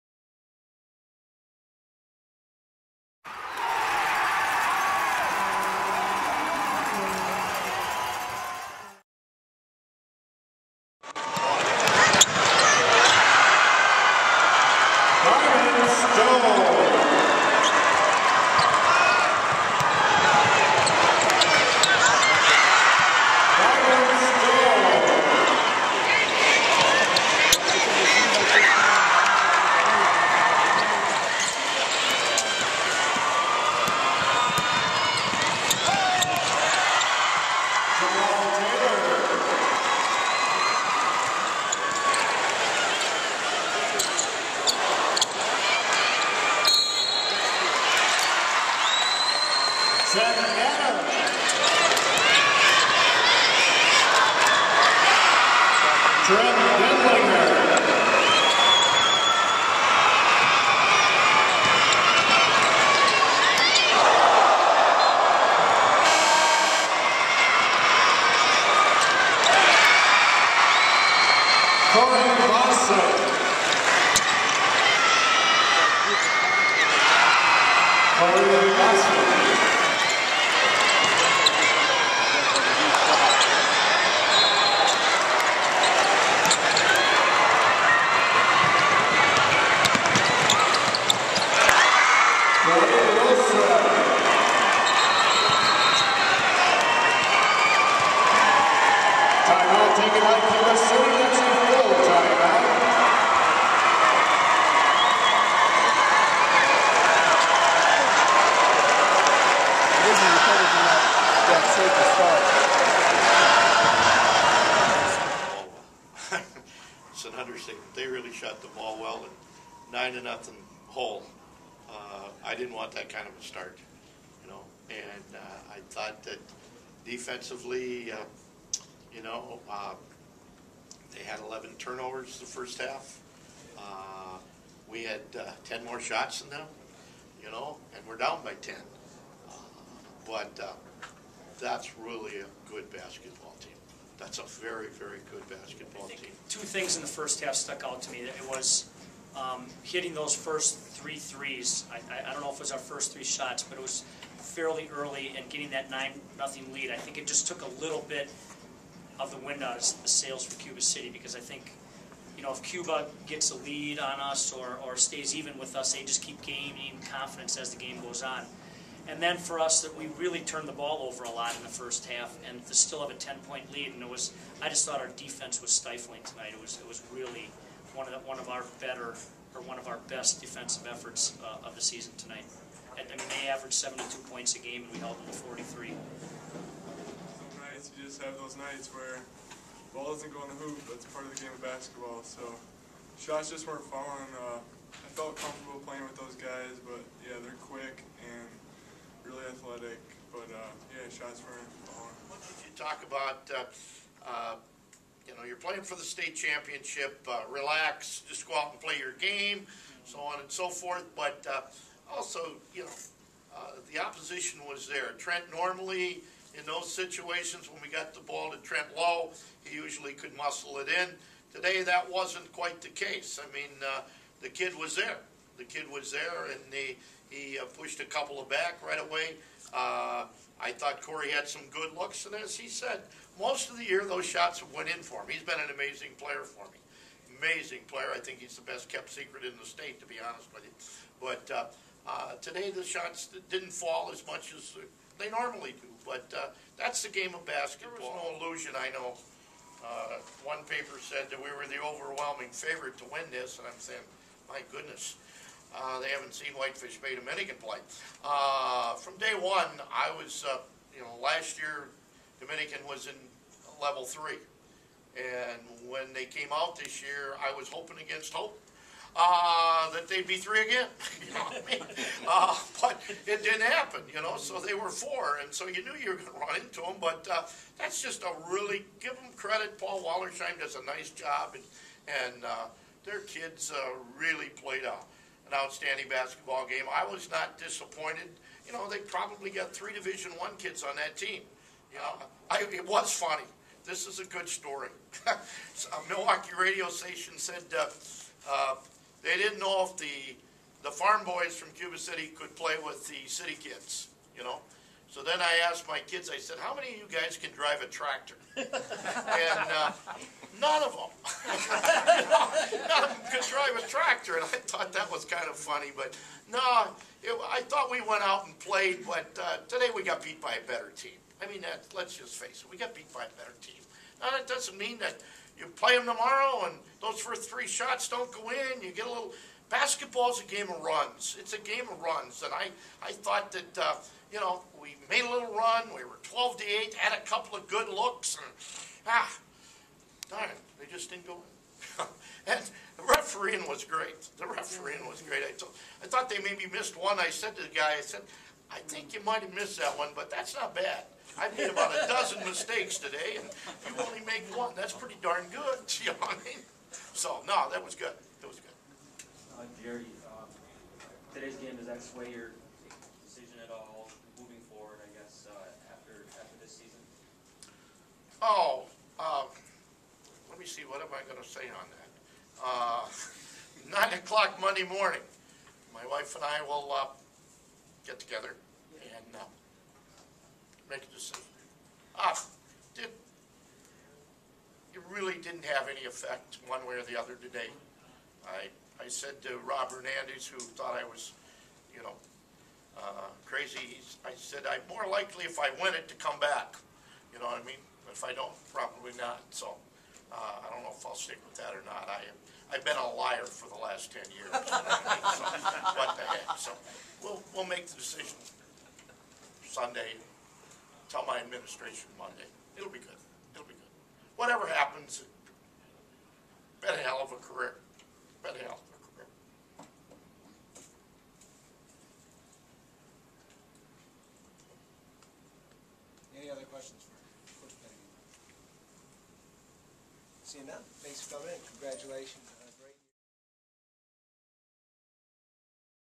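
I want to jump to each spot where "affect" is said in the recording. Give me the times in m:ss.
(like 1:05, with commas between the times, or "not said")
not said.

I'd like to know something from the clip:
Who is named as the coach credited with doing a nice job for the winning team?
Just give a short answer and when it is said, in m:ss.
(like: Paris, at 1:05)
Paul Wallersheim, at 4:39.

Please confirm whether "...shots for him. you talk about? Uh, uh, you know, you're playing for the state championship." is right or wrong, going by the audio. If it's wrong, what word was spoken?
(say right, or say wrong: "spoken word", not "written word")
right.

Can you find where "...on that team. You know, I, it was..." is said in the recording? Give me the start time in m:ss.
4:50.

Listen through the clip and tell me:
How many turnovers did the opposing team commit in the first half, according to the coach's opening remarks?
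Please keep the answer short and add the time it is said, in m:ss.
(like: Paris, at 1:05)
11, at 2:11.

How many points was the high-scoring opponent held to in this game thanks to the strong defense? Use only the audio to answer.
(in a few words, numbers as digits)
43.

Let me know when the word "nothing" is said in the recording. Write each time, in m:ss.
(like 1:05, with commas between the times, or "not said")
2:00, 2:36.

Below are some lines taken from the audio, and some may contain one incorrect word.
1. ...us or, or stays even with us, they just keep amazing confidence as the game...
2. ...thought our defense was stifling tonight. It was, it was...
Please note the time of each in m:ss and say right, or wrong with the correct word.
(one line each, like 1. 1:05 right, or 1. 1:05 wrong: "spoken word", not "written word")
1. 2:44 wrong: "gaining", not "amazing"
2. 2:54 right.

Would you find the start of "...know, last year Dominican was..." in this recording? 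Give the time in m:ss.
4:21.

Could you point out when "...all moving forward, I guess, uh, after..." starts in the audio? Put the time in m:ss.
6:03.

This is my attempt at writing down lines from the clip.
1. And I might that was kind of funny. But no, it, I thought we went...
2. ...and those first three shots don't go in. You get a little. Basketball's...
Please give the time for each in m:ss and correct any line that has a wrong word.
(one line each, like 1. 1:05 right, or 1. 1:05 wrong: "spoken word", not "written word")
1. 5:14 wrong: "thought", not "might"
2. 5:26 right.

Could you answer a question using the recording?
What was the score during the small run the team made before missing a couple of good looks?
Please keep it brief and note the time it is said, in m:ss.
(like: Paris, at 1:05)
12-8, at 5:36.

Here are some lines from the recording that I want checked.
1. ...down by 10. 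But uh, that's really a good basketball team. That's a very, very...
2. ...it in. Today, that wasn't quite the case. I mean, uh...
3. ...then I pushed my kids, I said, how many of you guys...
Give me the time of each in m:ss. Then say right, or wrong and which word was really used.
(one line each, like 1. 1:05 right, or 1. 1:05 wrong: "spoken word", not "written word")
1. 2:18 right
2. 3:40 right
3. 5:05 wrong: "asked", not "pushed".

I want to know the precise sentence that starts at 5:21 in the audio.
I mean, that, let's just face it, we got beat by a better team.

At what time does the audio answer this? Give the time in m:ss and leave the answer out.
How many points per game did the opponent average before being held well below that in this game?
3:03.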